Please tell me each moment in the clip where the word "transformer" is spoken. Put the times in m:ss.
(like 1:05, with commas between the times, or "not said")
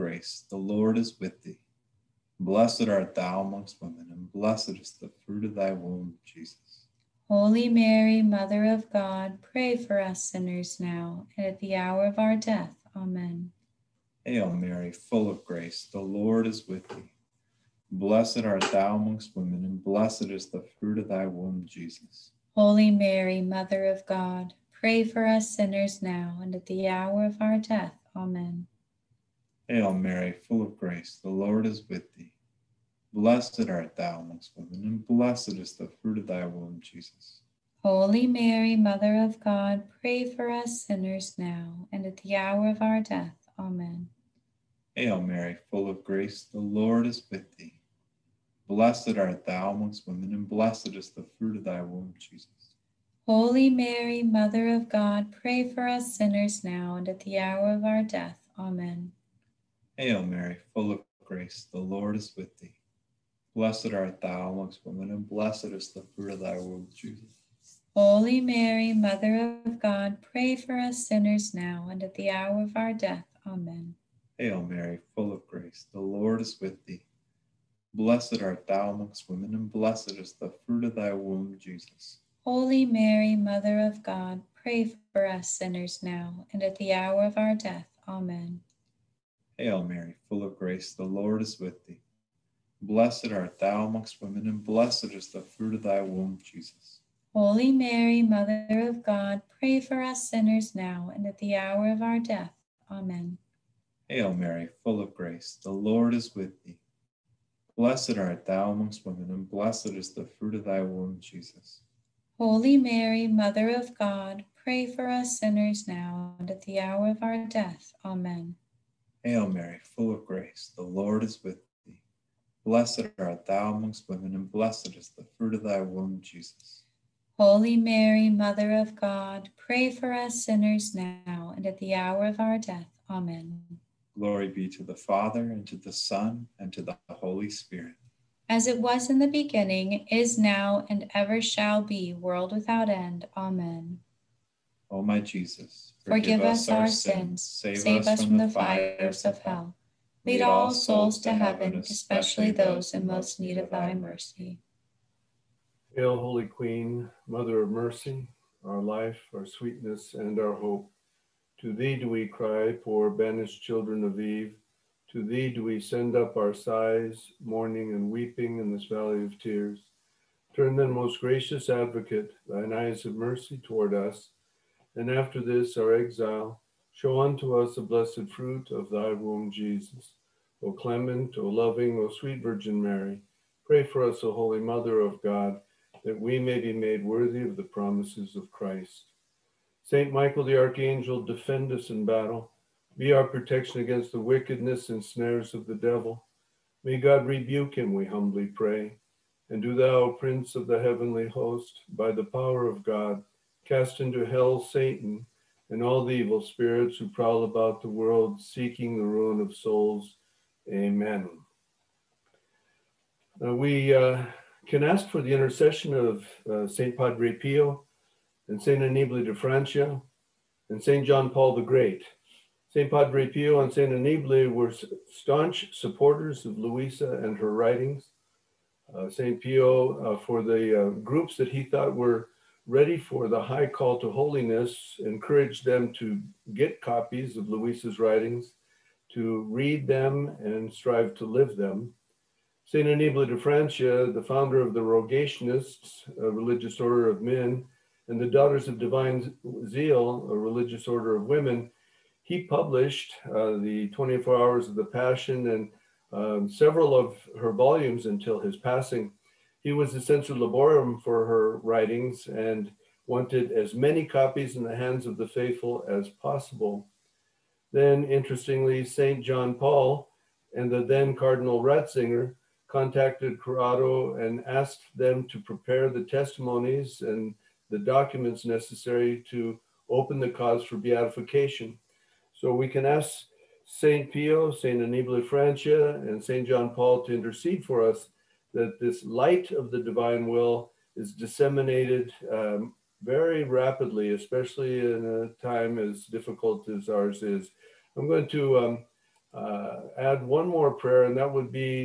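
not said.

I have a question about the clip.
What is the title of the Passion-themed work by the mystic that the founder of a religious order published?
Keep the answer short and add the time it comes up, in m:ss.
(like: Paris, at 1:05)
24 Hours of the Passion, at 4:13.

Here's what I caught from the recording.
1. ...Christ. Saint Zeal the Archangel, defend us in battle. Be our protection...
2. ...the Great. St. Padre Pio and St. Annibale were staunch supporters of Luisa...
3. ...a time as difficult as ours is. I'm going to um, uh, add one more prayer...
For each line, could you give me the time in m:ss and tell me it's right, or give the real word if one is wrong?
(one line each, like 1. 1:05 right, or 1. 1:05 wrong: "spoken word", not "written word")
1. 3:08 wrong: "Michael", not "Zeal"
2. 3:41 right
3. 4:55 right.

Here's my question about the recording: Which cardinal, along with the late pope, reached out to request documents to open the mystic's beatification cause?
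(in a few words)
Cardinal Ratzinger.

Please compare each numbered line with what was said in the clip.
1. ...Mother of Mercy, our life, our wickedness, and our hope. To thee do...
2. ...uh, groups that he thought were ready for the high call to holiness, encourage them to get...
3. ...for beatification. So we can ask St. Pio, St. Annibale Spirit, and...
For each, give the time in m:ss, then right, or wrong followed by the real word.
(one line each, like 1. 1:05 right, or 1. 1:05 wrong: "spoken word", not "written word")
1. 2:37 wrong: "sweetness", not "wickedness"
2. 3:50 right
3. 4:40 wrong: "Francia", not "Spirit".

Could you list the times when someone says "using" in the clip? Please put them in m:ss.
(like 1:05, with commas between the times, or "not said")
not said.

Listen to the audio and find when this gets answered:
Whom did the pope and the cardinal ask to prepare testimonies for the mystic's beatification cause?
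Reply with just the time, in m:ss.
4:33.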